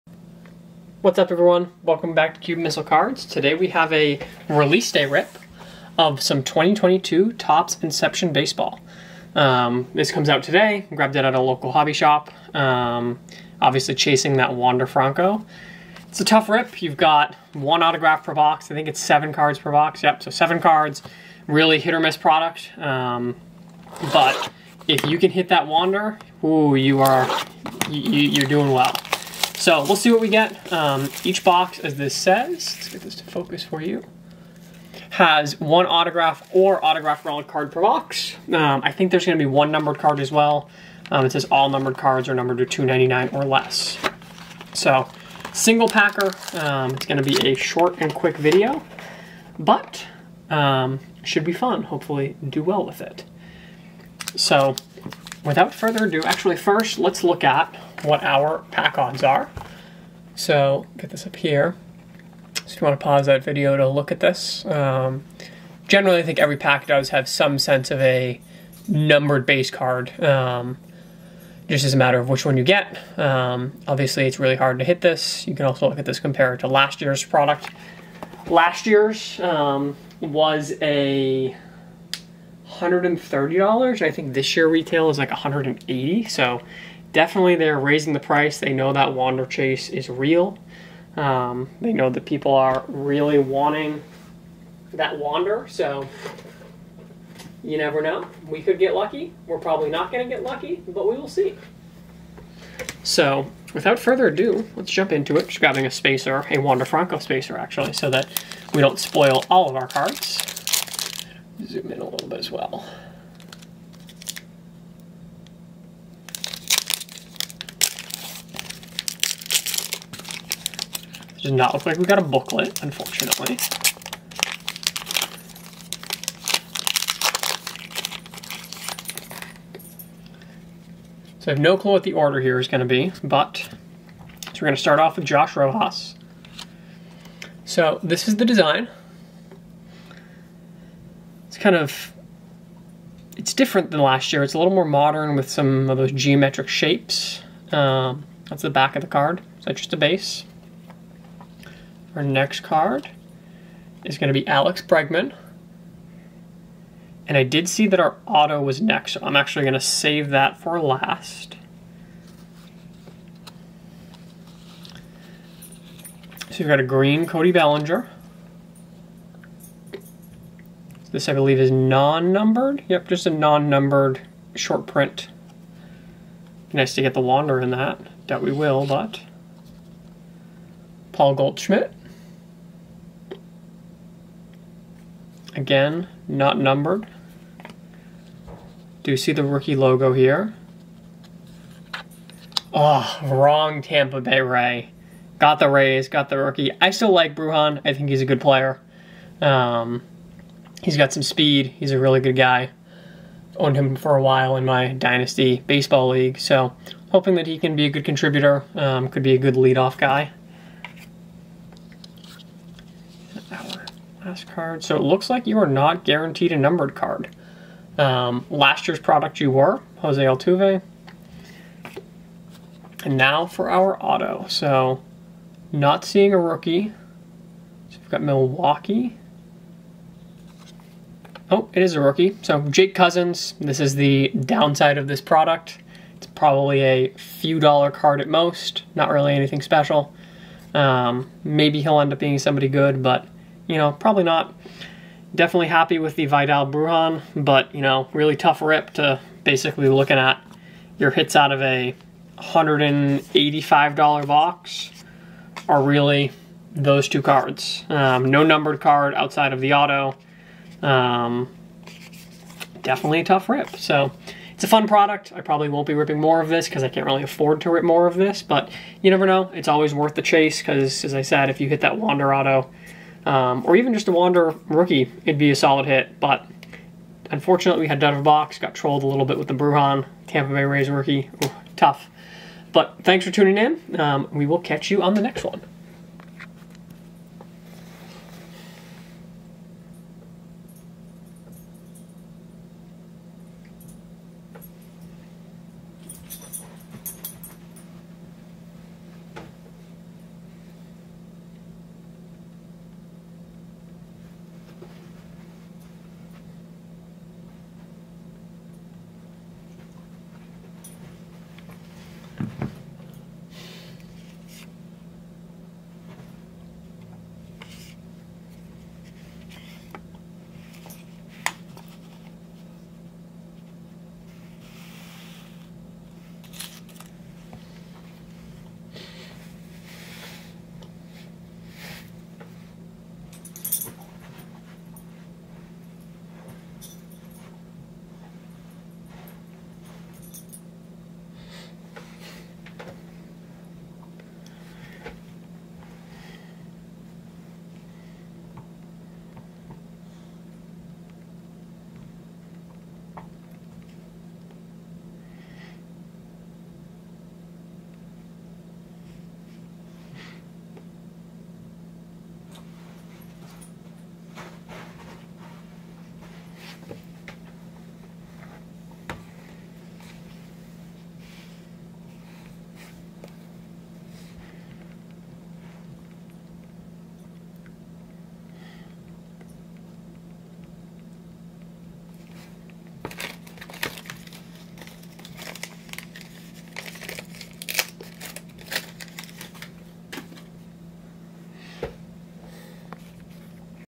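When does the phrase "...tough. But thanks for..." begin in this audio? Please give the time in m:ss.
4:41.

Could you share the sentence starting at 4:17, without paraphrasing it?
Um, no numbered card outside of the auto.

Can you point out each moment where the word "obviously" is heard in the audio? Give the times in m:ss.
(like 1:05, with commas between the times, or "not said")
0:13, 1:13.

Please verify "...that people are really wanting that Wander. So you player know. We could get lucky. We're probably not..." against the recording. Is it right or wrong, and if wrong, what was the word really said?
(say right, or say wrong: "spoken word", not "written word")
wrong: "never", not "player".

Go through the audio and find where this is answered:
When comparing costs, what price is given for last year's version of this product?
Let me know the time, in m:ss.
1:22.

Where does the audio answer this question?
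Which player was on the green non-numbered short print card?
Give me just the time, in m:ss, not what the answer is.
2:47.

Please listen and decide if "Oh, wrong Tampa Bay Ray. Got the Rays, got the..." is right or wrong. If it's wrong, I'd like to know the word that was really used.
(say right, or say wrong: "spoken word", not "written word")
right.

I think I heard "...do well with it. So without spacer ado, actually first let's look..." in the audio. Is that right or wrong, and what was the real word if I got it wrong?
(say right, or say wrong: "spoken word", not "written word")
wrong: "further", not "spacer".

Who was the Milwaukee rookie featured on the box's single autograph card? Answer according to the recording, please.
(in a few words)
Jake Cousins.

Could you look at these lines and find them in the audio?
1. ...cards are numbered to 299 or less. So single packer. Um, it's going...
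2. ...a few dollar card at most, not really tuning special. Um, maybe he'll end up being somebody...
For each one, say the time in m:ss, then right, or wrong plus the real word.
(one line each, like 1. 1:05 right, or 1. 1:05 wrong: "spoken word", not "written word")
1. 0:41 right
2. 3:56 wrong: "anything", not "tuning".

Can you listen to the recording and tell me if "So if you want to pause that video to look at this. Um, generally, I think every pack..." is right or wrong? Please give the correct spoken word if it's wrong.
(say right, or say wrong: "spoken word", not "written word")
right.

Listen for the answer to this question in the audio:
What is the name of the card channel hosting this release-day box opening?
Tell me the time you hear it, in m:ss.
0:02.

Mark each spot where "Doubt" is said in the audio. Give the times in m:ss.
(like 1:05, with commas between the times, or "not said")
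2:58.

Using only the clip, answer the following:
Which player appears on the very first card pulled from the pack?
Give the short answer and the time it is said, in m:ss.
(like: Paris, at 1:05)
Josh Rojas, at 2:15.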